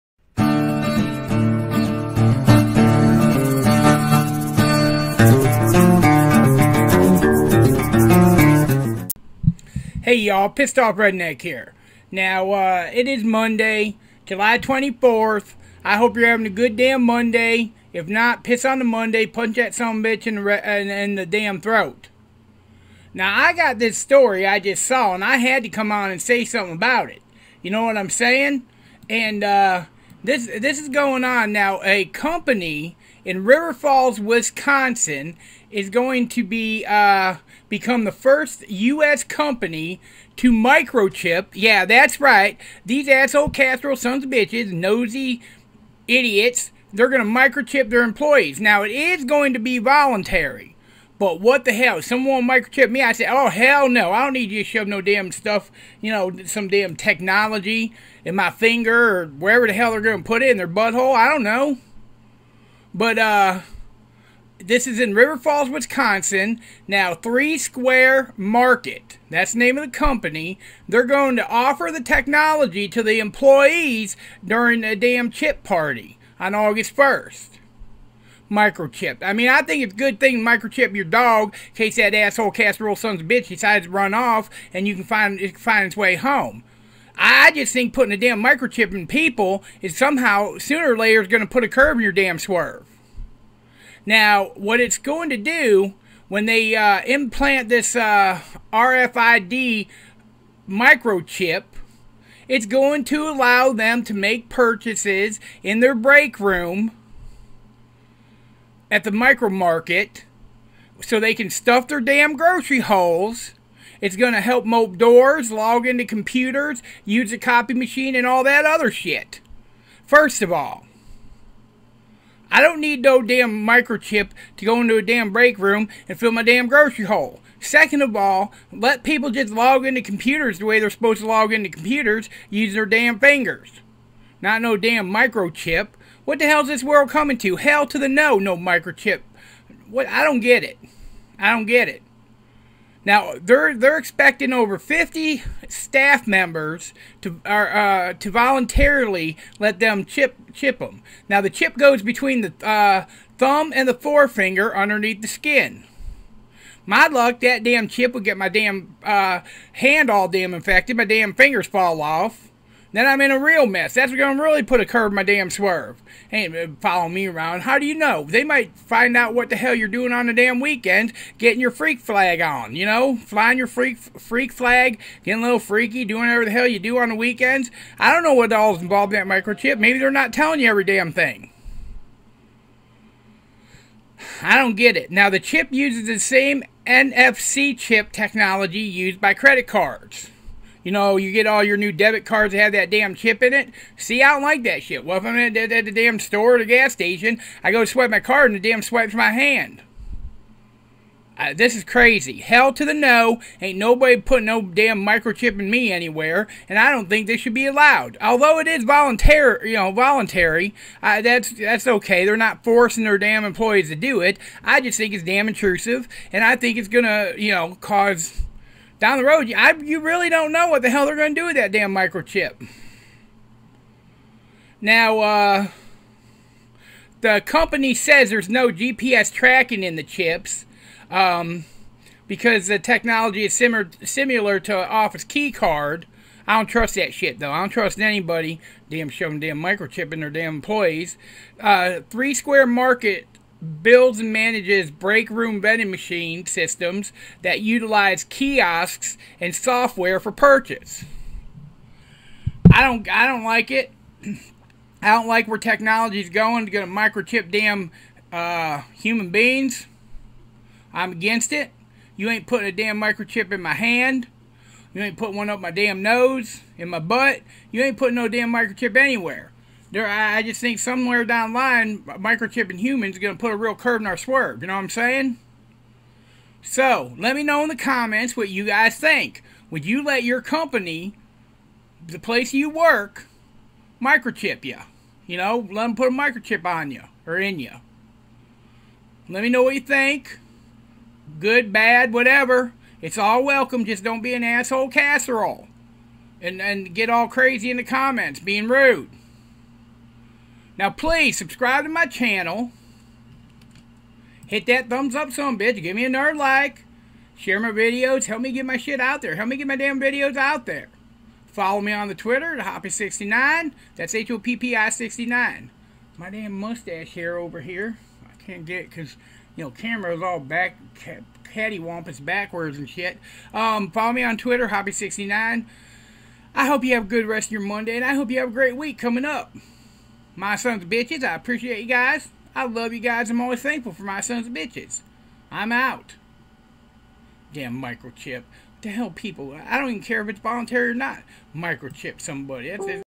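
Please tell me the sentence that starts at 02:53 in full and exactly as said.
Flying your freak freak flag, getting a little freaky, doing whatever the hell you do on the weekends.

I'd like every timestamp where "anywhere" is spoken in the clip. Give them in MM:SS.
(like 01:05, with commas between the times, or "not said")
03:25, 04:28.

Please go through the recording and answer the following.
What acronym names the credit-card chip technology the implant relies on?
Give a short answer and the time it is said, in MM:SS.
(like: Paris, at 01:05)
NFC, at 03:06.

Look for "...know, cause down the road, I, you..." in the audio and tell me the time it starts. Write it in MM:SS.
03:37.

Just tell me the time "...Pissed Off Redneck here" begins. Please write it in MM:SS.
00:10.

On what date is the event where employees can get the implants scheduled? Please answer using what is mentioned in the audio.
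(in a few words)
August 1st.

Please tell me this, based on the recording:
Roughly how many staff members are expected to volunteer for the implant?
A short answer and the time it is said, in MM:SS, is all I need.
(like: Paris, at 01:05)
over 50, at 02:24.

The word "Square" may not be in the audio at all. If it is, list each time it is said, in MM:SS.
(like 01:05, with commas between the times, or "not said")
01:07, 04:02.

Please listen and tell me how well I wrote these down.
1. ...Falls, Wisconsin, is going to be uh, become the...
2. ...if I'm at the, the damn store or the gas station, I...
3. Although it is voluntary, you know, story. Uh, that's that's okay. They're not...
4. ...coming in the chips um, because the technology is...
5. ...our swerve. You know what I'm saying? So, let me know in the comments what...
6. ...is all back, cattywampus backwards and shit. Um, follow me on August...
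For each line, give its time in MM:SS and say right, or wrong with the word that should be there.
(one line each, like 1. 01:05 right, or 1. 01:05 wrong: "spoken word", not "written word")
1. 00:33 right
2. 03:15 right
3. 03:28 wrong: "voluntary", not "story"
4. 03:49 wrong: "tracking", not "coming"
5. 04:34 right
6. 05:20 wrong: "Twitter", not "August".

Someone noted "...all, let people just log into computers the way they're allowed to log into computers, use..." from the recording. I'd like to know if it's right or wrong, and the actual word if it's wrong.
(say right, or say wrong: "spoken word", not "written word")
wrong: "supposed", not "allowed".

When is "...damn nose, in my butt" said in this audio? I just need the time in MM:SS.
04:25.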